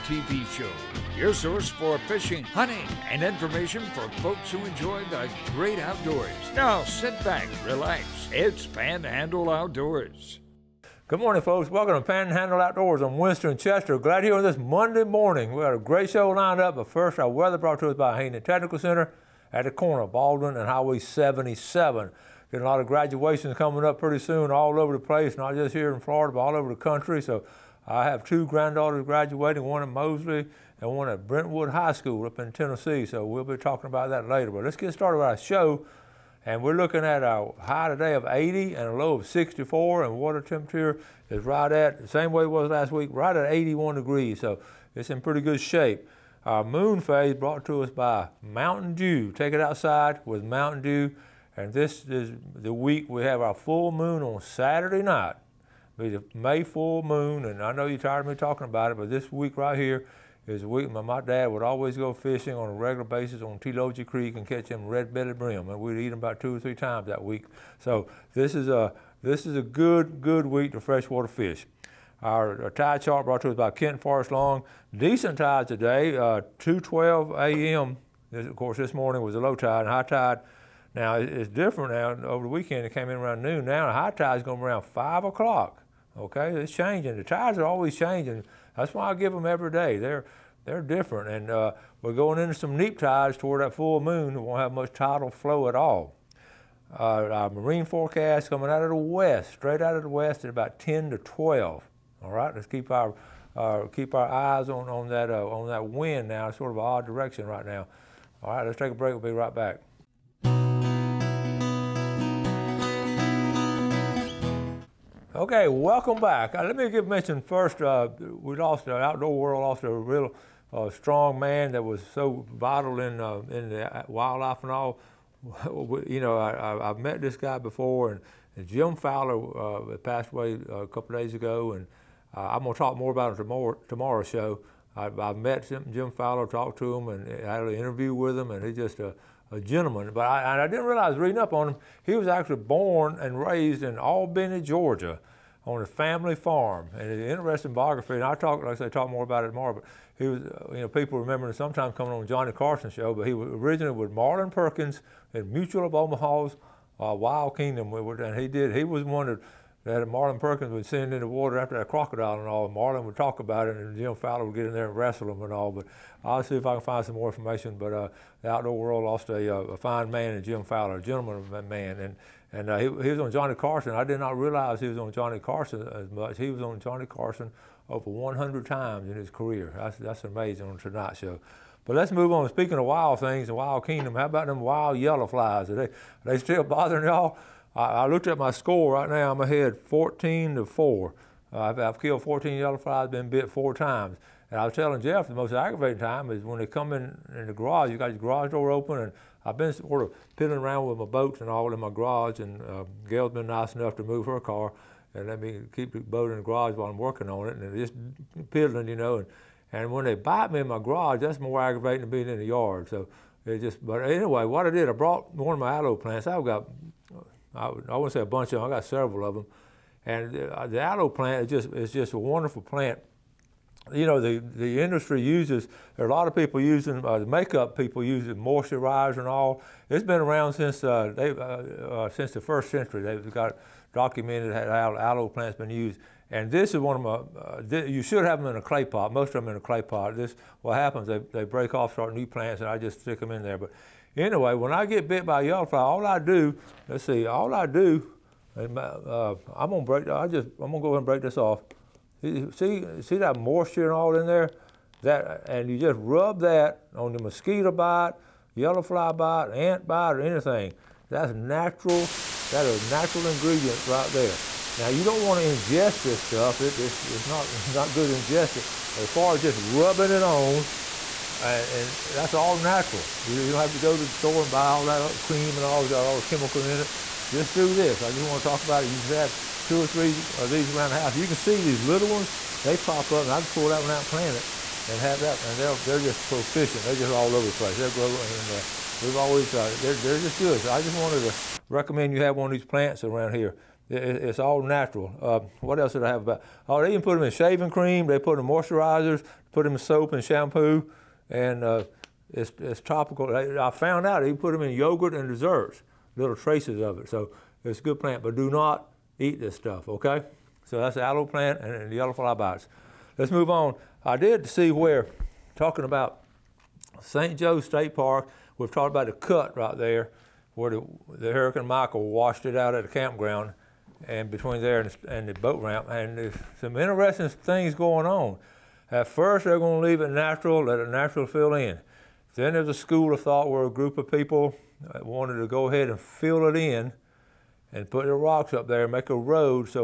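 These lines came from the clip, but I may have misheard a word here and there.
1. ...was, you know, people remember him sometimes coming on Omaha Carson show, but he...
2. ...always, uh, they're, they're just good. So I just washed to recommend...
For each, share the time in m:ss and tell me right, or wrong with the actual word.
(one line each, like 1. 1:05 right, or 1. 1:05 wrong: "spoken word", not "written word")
1. 2:30 wrong: "Johnny", not "Omaha"
2. 4:49 wrong: "wanted", not "washed".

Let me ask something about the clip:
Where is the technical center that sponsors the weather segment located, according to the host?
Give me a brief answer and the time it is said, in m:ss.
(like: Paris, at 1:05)
Baldwin and Highway 77, at 0:20.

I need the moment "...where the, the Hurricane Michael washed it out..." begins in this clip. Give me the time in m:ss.
5:20.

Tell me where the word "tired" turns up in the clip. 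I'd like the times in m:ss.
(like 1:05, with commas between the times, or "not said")
0:57.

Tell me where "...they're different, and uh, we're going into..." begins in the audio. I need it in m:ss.
1:30.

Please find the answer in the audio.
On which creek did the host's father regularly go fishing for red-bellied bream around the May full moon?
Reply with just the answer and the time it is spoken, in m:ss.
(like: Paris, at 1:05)
Telogia Creek, at 1:03.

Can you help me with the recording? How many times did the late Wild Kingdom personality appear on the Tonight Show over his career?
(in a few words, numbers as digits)
Over 100.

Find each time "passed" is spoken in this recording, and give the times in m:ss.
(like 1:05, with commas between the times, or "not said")
2:09.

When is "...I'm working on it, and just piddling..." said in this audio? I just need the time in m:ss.
3:26.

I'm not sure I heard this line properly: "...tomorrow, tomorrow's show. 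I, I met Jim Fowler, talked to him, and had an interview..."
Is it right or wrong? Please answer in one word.
right.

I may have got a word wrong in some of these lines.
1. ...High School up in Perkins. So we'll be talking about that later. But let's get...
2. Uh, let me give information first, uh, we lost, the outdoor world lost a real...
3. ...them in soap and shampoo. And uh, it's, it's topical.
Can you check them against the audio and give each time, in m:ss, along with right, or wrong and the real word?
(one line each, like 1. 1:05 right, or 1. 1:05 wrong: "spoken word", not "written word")
1. 0:31 wrong: "Tennessee", not "Perkins"
2. 1:56 wrong: "mention", not "information"
3. 4:59 right.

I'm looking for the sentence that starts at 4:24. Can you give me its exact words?
Now you don't want to ingest this stuff.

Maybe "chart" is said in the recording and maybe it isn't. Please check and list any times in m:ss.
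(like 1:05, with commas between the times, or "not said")
1:13.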